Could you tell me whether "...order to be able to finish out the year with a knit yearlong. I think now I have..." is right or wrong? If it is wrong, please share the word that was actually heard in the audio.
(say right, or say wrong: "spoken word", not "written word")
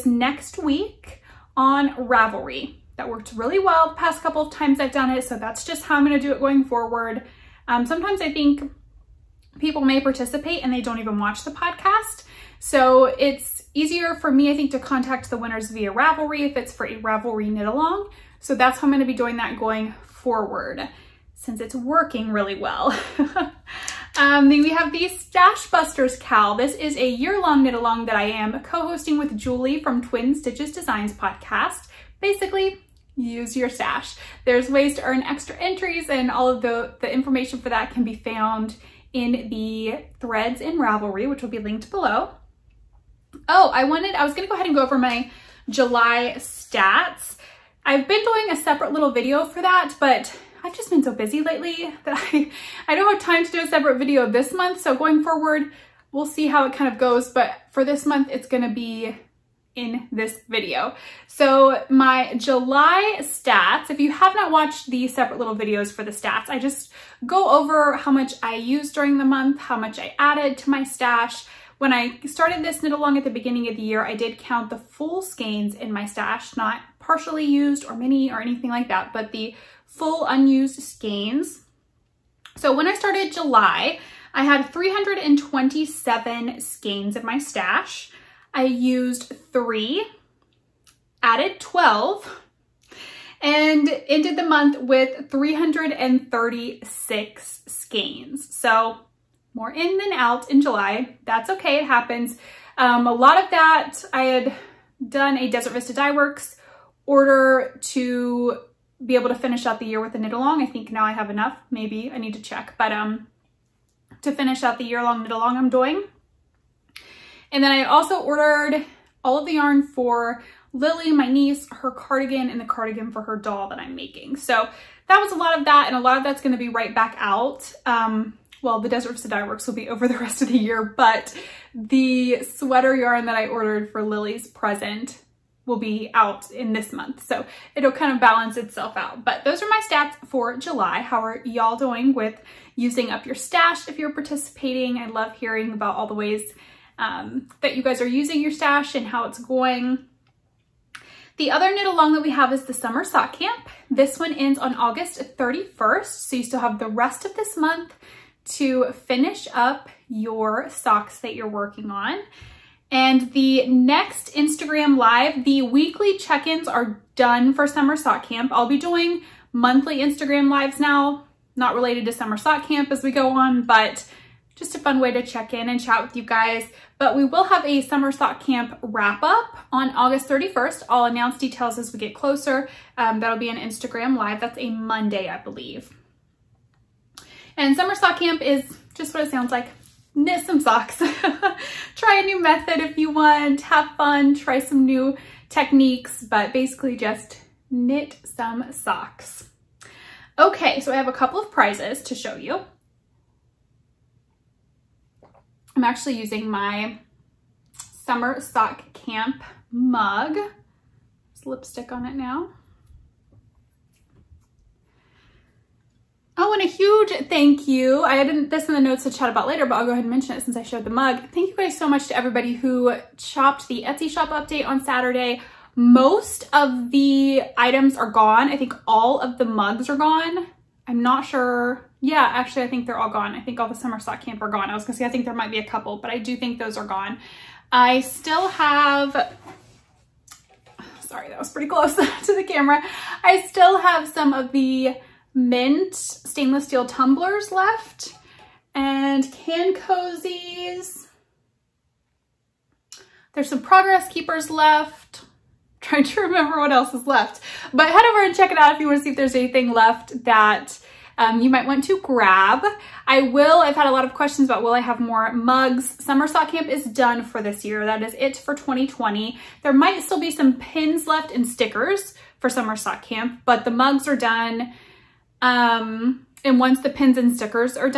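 wrong: "along", not "yearlong".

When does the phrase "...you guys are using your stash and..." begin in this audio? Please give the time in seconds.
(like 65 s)
147 s.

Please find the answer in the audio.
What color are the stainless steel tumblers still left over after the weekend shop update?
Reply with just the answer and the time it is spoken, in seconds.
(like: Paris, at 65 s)
mint, at 245 s.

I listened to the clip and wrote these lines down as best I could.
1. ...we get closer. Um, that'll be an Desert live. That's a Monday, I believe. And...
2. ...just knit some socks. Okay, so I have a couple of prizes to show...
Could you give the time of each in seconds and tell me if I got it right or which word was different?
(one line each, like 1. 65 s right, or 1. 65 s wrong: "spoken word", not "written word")
1. 181 s wrong: "Instagram", not "Desert"
2. 196 s right.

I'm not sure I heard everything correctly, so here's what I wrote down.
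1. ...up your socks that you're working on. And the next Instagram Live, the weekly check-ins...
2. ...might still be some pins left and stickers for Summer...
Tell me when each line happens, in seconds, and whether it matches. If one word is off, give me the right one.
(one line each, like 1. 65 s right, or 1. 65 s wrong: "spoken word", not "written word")
1. 159 s right
2. 269 s right.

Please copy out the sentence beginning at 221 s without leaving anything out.
Thank you guys so much to everybody who chopped the Etsy shop update on Saturday.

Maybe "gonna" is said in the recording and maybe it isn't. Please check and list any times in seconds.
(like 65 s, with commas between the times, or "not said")
18 s, 44 s, 58 s, 126 s, 234 s.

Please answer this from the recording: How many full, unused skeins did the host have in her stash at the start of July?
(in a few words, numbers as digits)
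327.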